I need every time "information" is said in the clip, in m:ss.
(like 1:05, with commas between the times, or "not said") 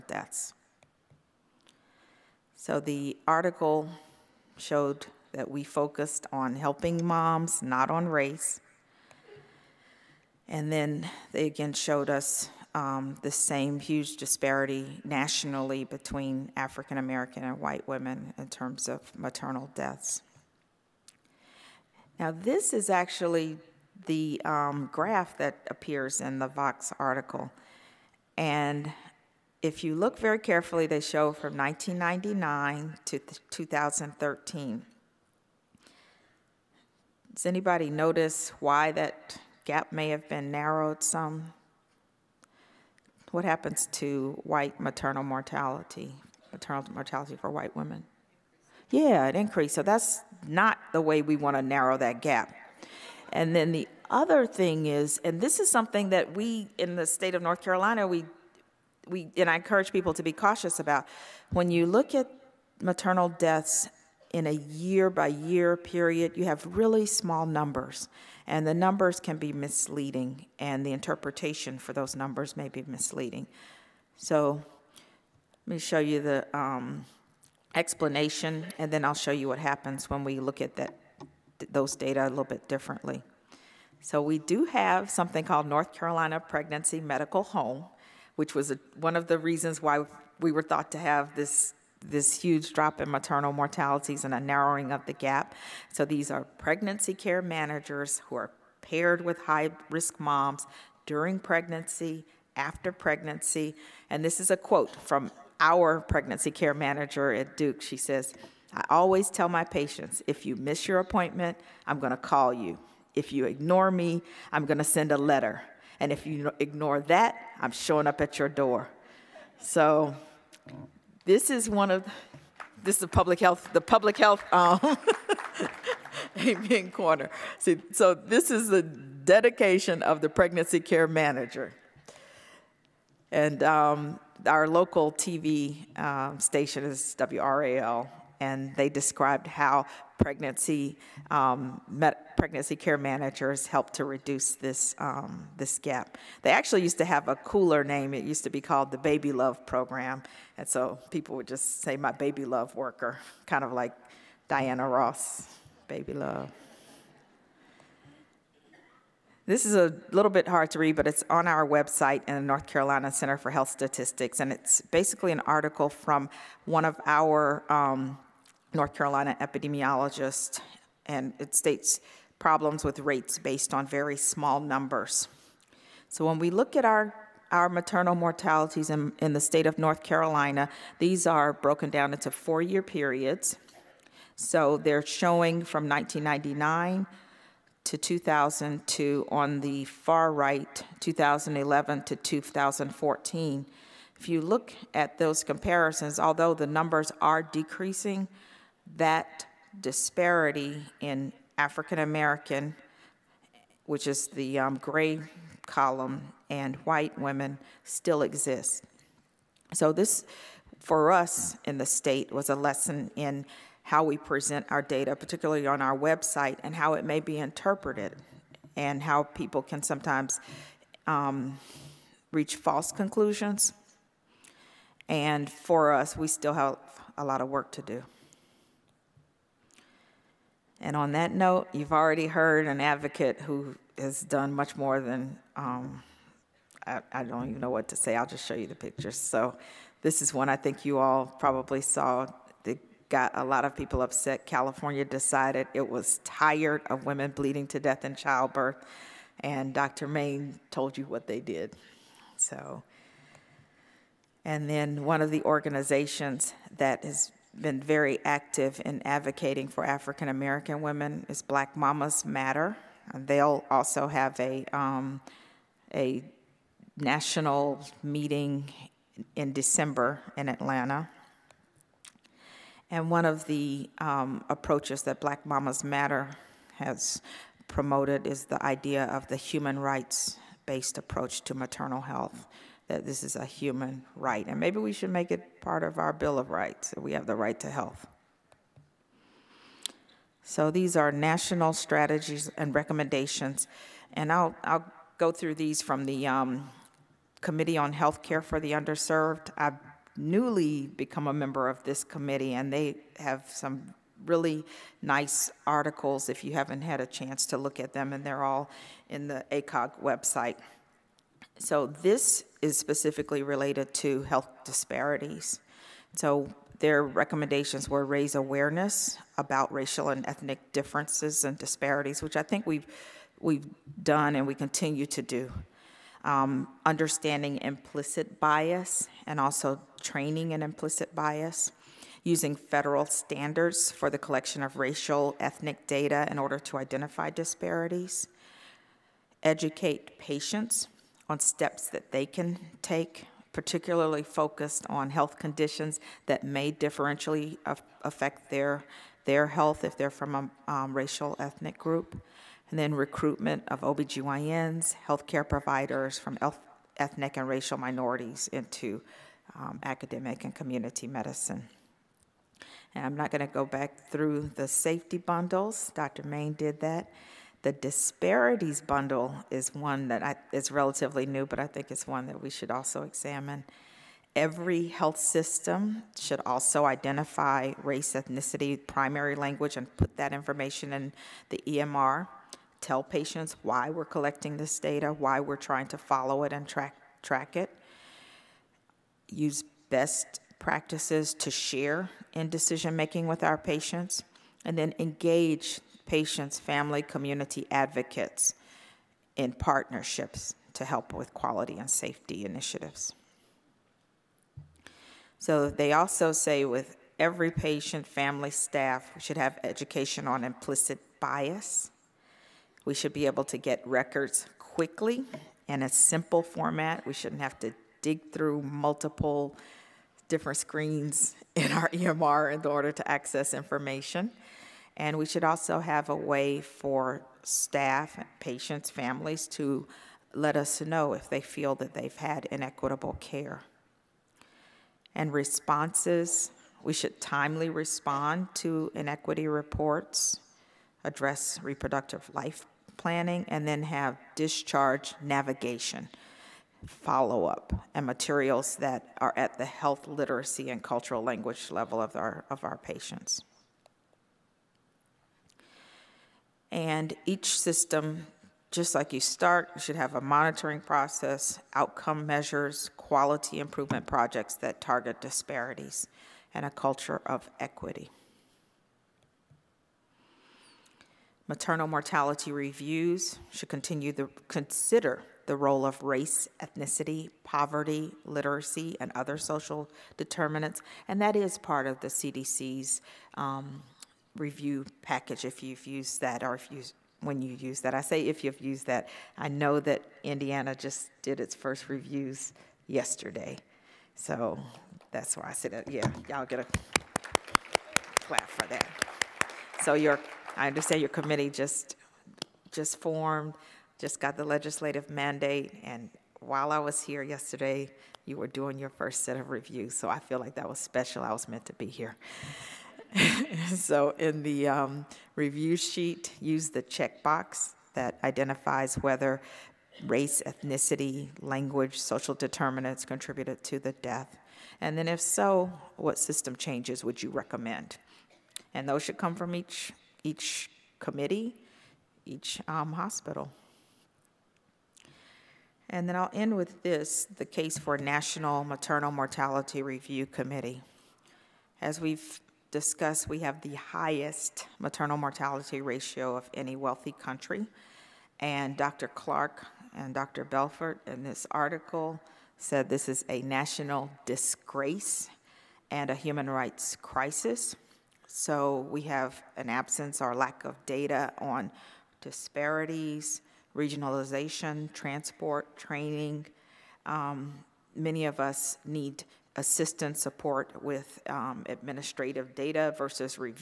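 6:20, 7:03.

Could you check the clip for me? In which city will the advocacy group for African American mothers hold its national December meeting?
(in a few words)
Atlanta.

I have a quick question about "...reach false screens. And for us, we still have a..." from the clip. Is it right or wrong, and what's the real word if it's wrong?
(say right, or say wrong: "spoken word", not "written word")
wrong: "conclusions", not "screens".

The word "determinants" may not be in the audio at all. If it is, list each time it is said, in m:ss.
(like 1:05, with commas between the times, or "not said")
8:00, 8:42.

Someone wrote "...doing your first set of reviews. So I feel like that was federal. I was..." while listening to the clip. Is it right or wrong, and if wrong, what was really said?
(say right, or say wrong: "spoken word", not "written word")
wrong: "special", not "federal".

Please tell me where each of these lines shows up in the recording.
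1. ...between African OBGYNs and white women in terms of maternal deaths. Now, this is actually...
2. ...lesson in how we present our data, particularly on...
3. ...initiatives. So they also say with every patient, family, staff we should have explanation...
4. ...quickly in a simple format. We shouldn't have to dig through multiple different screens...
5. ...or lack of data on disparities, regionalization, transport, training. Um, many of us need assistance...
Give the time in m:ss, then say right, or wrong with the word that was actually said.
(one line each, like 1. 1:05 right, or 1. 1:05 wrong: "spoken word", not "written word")
1. 0:15 wrong: "American", not "OBGYNs"
2. 3:32 right
3. 6:42 wrong: "education", not "explanation"
4. 6:54 right
5. 9:20 right.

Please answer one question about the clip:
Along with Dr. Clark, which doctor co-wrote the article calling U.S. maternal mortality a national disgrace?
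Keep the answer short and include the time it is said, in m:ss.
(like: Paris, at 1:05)
Dr. Belfort, at 9:10.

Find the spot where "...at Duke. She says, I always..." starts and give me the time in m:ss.
1:47.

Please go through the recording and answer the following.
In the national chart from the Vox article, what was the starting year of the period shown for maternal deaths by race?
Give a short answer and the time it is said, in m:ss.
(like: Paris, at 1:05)
1999, at 0:31.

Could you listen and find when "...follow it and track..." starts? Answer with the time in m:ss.
6:25.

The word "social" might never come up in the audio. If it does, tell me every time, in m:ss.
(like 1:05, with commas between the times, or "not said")
7:59, 8:41.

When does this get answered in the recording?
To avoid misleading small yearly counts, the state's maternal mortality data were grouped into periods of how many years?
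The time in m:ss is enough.
3:02.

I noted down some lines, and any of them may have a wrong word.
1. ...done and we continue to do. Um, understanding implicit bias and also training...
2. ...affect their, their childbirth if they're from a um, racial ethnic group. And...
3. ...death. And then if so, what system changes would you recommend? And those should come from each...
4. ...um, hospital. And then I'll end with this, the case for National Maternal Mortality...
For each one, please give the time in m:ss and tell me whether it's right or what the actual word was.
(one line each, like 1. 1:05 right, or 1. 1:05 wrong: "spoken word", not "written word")
1. 5:24 right
2. 5:48 wrong: "health", not "childbirth"
3. 8:43 right
4. 8:52 right.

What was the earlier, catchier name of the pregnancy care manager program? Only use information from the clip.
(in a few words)
Baby Love Program.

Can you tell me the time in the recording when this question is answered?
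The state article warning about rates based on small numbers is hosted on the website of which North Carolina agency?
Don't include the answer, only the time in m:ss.
2:42.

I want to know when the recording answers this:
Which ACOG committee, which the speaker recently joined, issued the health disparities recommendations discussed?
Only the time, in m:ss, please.
4:57.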